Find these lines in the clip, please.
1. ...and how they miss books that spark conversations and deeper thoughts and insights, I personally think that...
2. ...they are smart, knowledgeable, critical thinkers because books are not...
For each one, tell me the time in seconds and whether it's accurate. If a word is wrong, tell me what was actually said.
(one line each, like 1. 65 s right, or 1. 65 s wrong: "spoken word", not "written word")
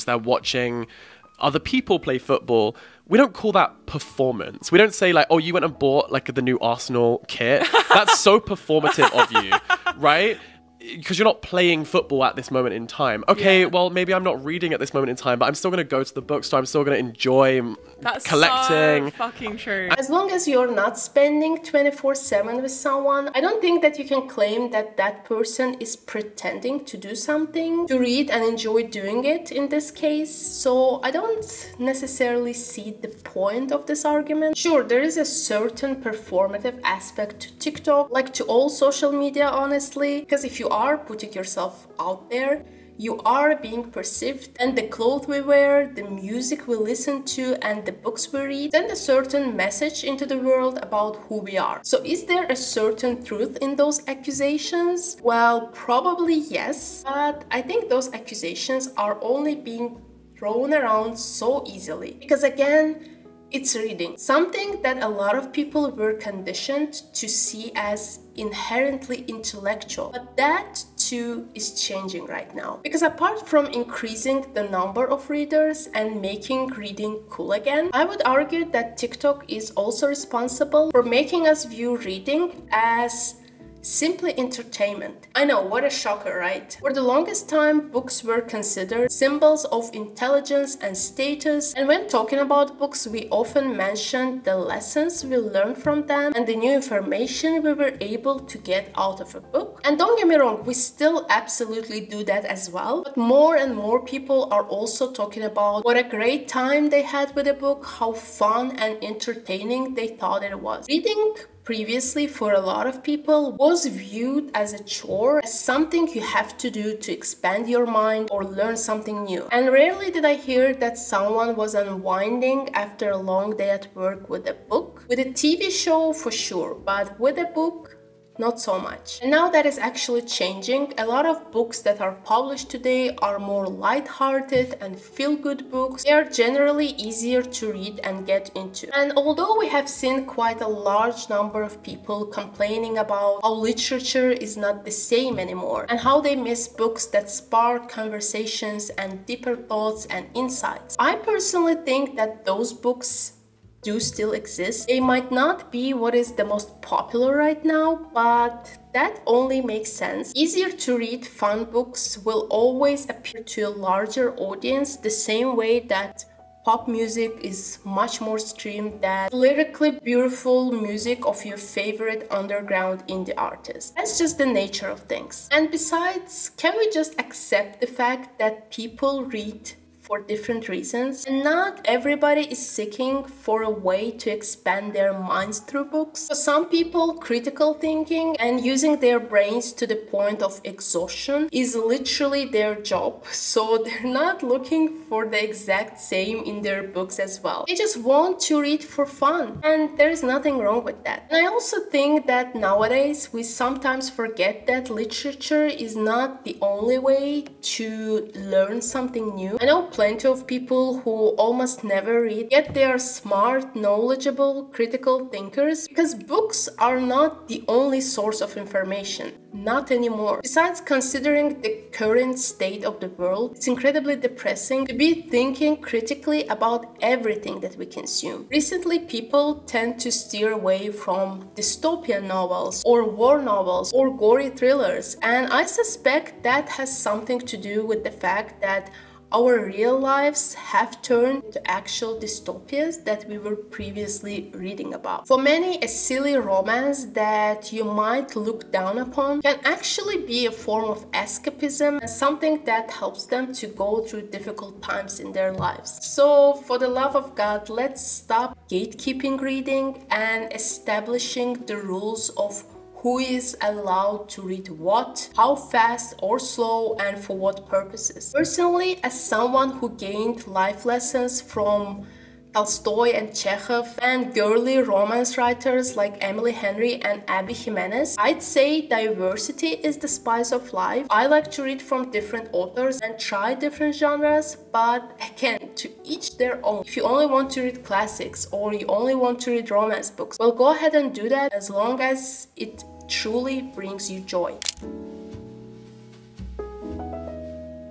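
1. 145 s right
2. 212 s right.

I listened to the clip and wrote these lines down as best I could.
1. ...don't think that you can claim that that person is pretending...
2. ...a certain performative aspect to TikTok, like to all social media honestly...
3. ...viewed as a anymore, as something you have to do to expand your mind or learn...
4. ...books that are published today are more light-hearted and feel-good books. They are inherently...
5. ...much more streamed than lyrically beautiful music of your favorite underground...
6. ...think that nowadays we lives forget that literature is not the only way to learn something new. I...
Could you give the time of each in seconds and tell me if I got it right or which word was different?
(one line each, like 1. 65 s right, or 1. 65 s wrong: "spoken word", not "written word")
1. 23 s right
2. 35 s right
3. 113 s wrong: "chore", not "anymore"
4. 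131 s wrong: "generally", not "inherently"
5. 167 s right
6. 201 s wrong: "sometimes", not "lives".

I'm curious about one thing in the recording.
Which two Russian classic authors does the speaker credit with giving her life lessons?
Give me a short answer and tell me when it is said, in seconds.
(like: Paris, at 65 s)
Tolstoy and Chekhov, at 272 s.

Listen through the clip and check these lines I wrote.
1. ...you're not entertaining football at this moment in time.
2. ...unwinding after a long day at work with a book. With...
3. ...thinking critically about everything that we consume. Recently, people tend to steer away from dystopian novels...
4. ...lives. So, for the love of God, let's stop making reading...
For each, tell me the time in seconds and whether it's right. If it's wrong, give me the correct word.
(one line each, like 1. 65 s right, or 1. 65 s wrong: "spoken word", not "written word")
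1. 11 s wrong: "playing", not "entertaining"
2. 121 s right
3. 225 s right
4. 255 s wrong: "gatekeeping", not "making".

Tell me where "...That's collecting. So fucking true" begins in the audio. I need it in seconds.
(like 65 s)
18 s.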